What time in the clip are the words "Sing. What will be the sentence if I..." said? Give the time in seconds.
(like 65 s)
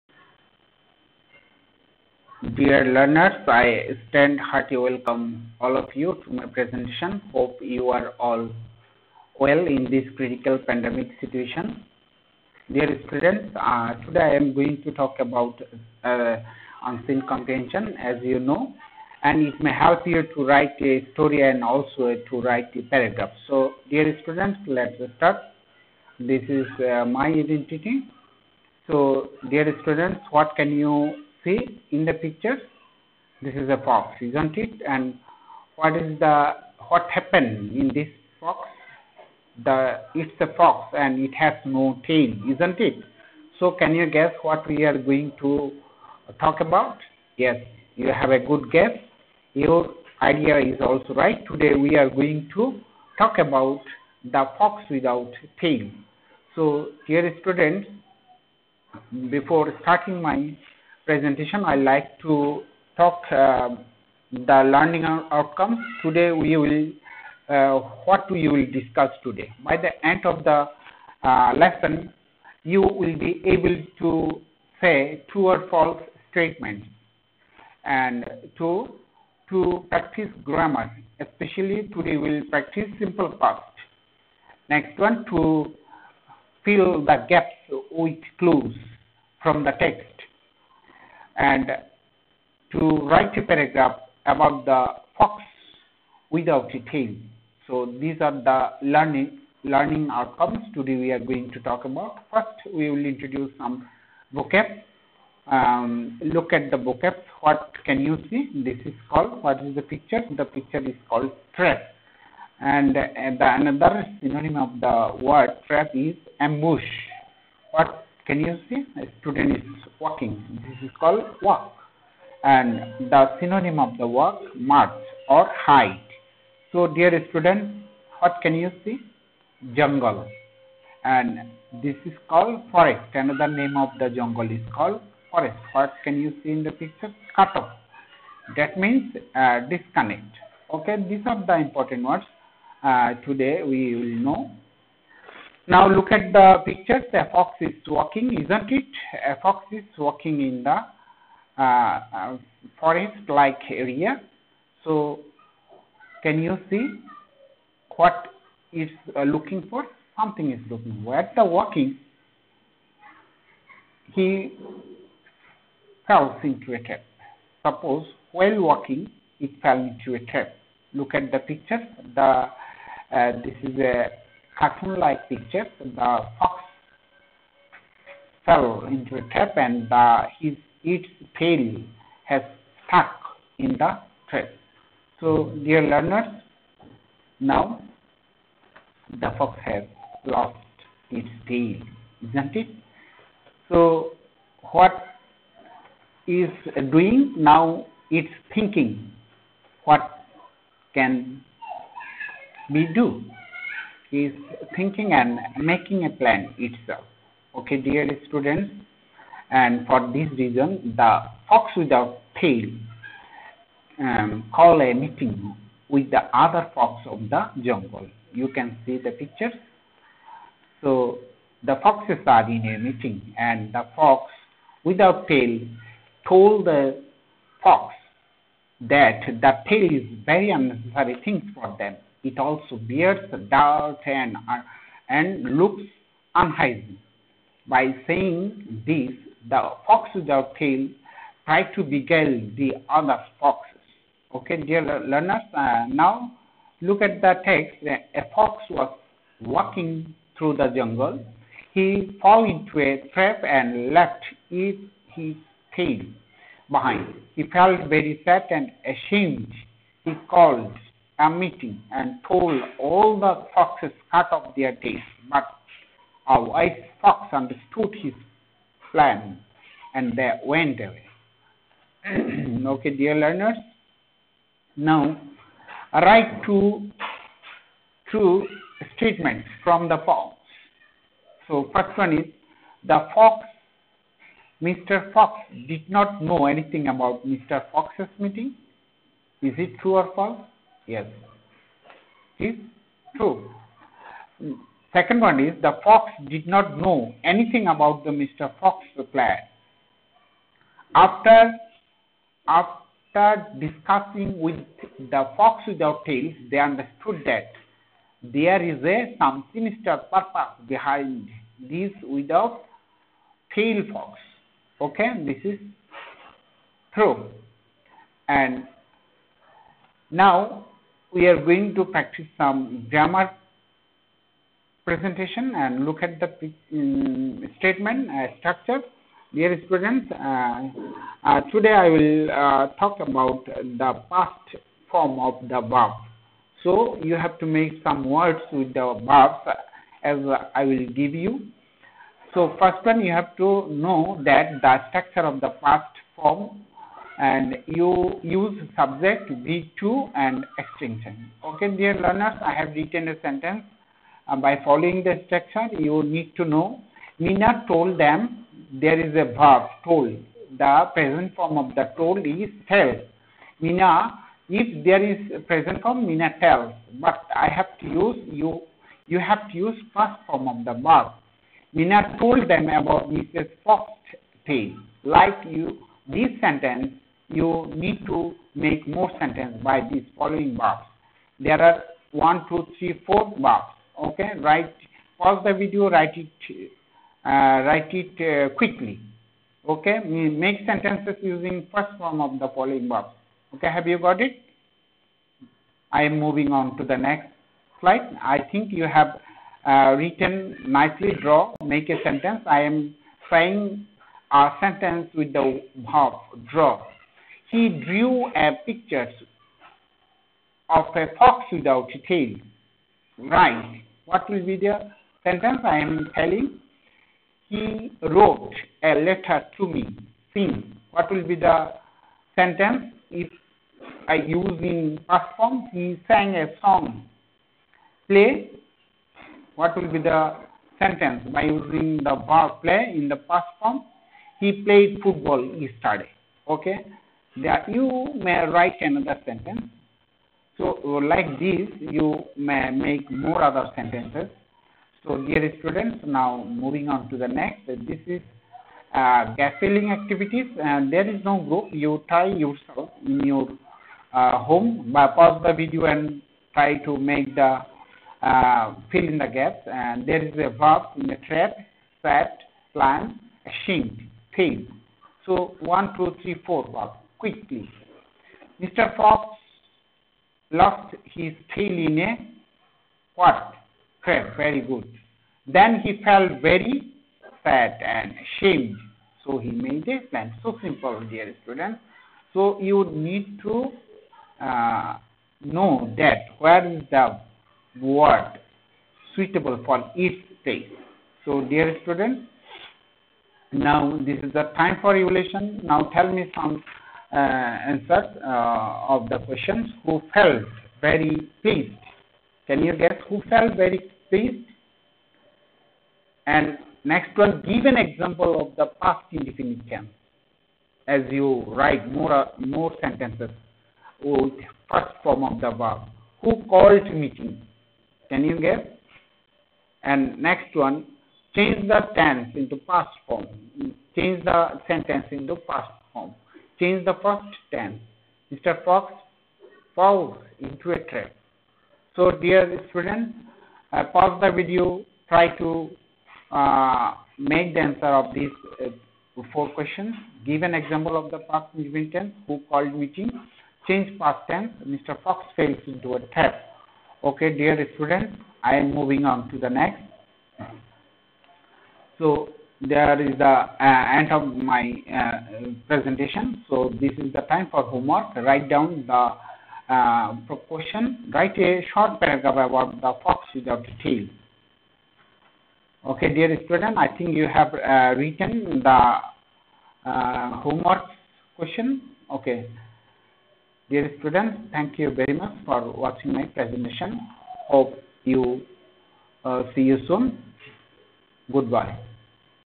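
420 s.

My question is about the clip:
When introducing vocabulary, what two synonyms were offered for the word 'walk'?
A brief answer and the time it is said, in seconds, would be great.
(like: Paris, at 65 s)
march or hike, at 124 s.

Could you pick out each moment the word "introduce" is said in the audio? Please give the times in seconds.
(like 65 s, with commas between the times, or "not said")
103 s.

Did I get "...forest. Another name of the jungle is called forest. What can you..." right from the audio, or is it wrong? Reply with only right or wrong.
right.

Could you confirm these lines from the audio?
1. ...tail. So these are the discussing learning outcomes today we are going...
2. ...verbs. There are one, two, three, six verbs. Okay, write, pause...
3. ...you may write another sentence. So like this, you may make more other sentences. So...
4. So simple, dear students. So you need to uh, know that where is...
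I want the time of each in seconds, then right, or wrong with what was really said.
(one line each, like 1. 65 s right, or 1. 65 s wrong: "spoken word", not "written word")
1. 96 s wrong: "learning", not "discussing"
2. 380 s wrong: "four", not "six"
3. 437 s right
4. 480 s right.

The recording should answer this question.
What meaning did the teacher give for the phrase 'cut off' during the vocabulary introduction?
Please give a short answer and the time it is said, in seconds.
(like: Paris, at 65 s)
disconnect, at 139 s.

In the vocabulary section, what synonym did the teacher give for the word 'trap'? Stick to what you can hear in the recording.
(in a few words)
ambush.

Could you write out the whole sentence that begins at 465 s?
So one, two, three, four verbs quickly.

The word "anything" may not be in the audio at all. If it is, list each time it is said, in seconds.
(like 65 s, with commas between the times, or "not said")
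286 s, 297 s.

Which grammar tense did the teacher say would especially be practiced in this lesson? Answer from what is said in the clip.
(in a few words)
simple past.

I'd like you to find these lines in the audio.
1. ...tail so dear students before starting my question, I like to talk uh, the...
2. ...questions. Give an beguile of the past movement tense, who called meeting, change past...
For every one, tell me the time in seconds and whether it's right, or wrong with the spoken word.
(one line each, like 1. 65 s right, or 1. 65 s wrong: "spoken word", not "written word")
1. 55 s wrong: "presentation", not "question"
2. 539 s wrong: "example", not "beguile".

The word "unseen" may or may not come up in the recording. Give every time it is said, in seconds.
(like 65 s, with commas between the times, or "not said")
16 s.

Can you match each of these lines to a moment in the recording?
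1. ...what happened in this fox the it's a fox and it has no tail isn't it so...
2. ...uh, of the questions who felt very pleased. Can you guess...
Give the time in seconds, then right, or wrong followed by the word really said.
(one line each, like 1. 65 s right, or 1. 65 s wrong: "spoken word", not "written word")
1. 36 s right
2. 498 s right.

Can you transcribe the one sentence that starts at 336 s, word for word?
So you have to make some words with the verbs as I will give you.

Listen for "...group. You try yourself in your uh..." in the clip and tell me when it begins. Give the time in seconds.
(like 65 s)
451 s.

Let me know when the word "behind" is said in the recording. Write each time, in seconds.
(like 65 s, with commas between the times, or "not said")
256 s, 310 s.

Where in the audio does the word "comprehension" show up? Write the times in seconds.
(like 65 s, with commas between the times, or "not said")
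17 s.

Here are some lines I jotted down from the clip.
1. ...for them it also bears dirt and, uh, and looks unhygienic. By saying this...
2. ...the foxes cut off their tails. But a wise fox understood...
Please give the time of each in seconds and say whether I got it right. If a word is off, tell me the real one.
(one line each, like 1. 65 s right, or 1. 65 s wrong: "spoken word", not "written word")
1. 231 s right
2. 263 s right.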